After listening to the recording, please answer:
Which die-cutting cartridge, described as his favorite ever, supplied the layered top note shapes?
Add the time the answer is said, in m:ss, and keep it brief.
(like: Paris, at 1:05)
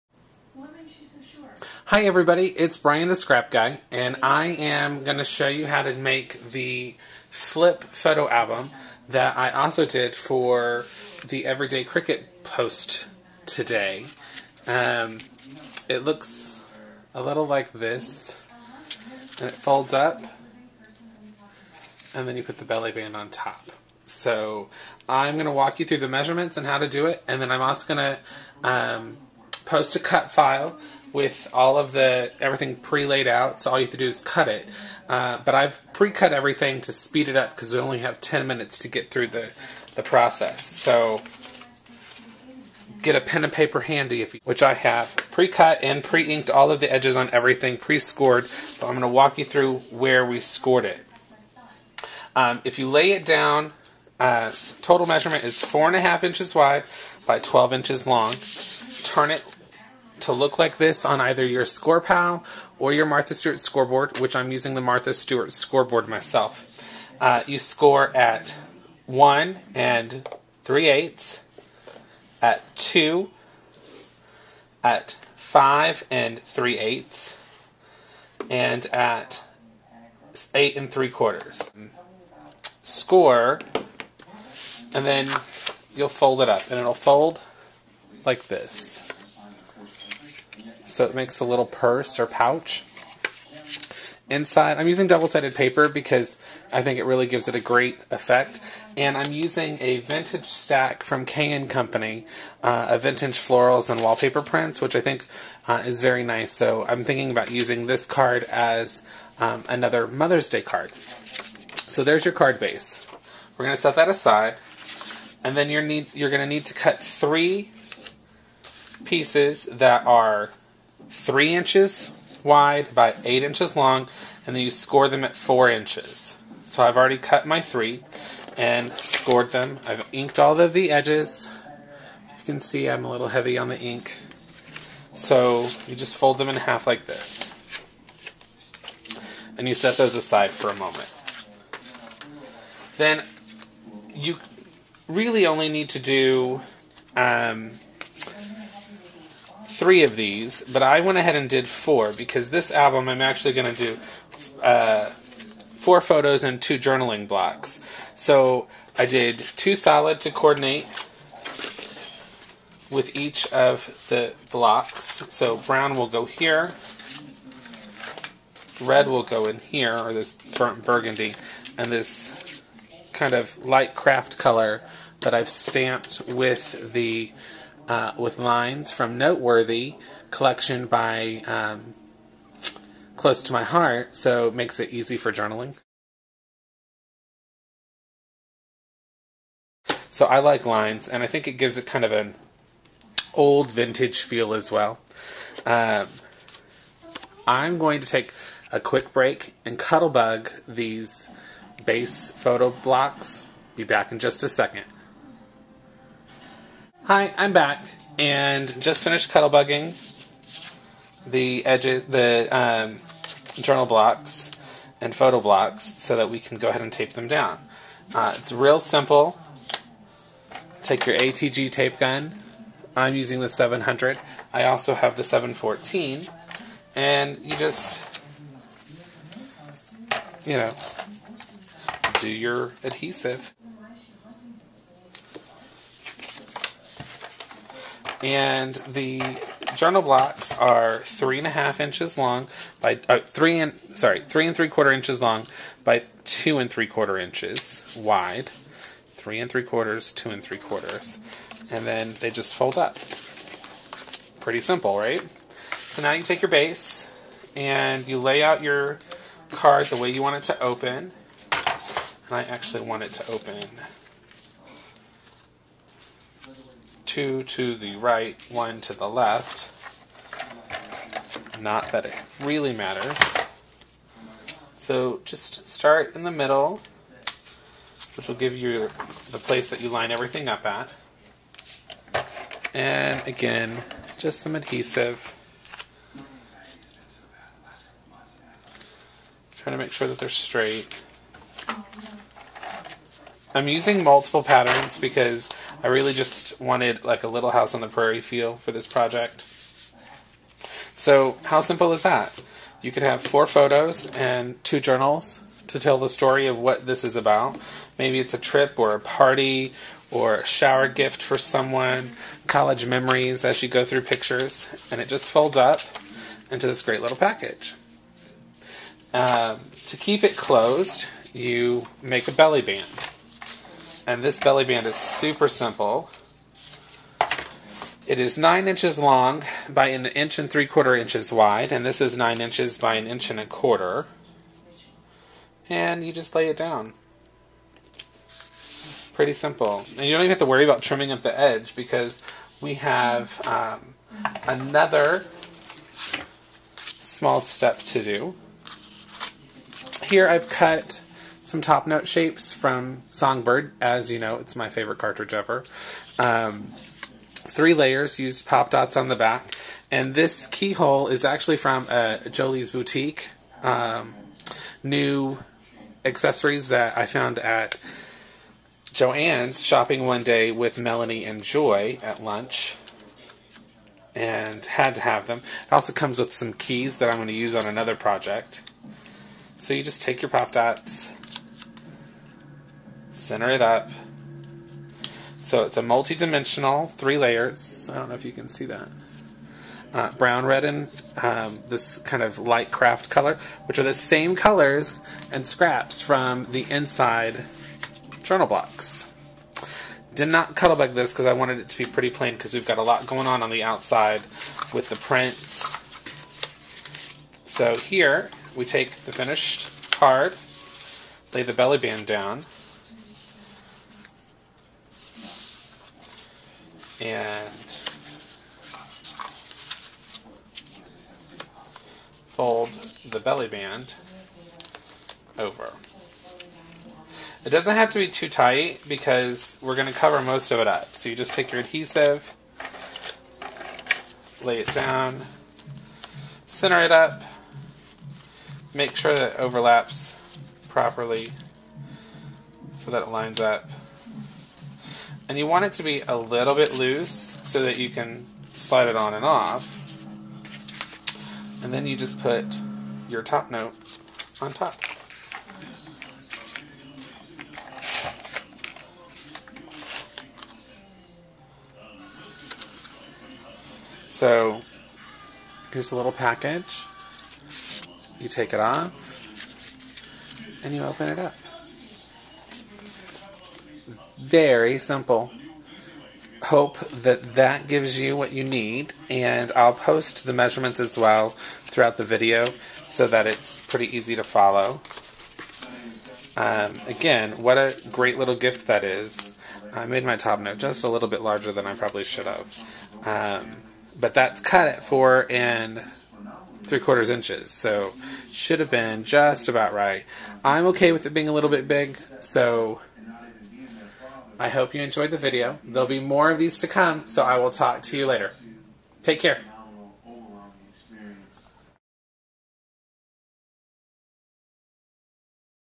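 Songbird, at 5:53.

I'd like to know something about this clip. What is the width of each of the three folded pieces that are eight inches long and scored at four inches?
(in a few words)
3 inches.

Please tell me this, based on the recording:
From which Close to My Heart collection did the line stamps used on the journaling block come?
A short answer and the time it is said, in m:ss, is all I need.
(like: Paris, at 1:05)
Noteworthy, at 2:59.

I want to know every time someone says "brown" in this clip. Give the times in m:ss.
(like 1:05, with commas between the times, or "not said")
2:45, 6:30.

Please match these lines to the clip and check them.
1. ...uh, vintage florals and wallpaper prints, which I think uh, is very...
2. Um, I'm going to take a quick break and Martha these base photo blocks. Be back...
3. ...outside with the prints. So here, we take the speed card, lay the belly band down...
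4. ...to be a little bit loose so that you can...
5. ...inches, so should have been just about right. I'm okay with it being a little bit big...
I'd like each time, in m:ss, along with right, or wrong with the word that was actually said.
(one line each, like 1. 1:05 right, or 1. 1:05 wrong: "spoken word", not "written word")
1. 1:42 right
2. 3:15 wrong: "Cuttlebug", not "Martha"
3. 6:43 wrong: "finished", not "speed"
4. 7:25 right
5. 8:17 right.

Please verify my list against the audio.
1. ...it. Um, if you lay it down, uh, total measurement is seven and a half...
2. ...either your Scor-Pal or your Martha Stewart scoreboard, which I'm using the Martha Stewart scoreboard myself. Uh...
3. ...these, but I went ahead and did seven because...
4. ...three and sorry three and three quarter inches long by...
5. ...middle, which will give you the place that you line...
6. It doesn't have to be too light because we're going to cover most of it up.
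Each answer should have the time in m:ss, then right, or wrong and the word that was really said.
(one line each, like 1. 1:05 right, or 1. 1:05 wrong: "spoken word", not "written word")
1. 0:50 wrong: "four", not "seven"
2. 1:01 right
3. 2:30 wrong: "four", not "seven"
4. 4:03 right
5. 4:36 right
6. 7:07 wrong: "tight", not "light".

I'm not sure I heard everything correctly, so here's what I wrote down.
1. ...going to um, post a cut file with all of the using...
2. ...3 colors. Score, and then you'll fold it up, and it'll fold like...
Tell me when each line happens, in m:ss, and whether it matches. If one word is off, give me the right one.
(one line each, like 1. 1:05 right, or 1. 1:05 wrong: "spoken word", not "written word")
1. 0:27 wrong: "everything", not "using"
2. 1:20 wrong: "quarters", not "colors".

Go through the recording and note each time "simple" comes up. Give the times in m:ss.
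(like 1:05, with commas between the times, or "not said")
3:38, 4:14, 5:01, 5:25, 5:39, 7:54.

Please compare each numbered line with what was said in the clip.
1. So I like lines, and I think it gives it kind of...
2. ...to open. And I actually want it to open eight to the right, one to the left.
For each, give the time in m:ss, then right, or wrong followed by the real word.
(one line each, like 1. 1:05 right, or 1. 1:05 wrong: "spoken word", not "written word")
1. 3:10 right
2. 4:20 wrong: "two", not "eight".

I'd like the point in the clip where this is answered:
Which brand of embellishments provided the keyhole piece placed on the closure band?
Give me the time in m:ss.
6:02.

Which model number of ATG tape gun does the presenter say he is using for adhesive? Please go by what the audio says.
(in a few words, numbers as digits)
700.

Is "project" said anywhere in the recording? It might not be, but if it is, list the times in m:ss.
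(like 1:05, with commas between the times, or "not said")
4:58, 6:17.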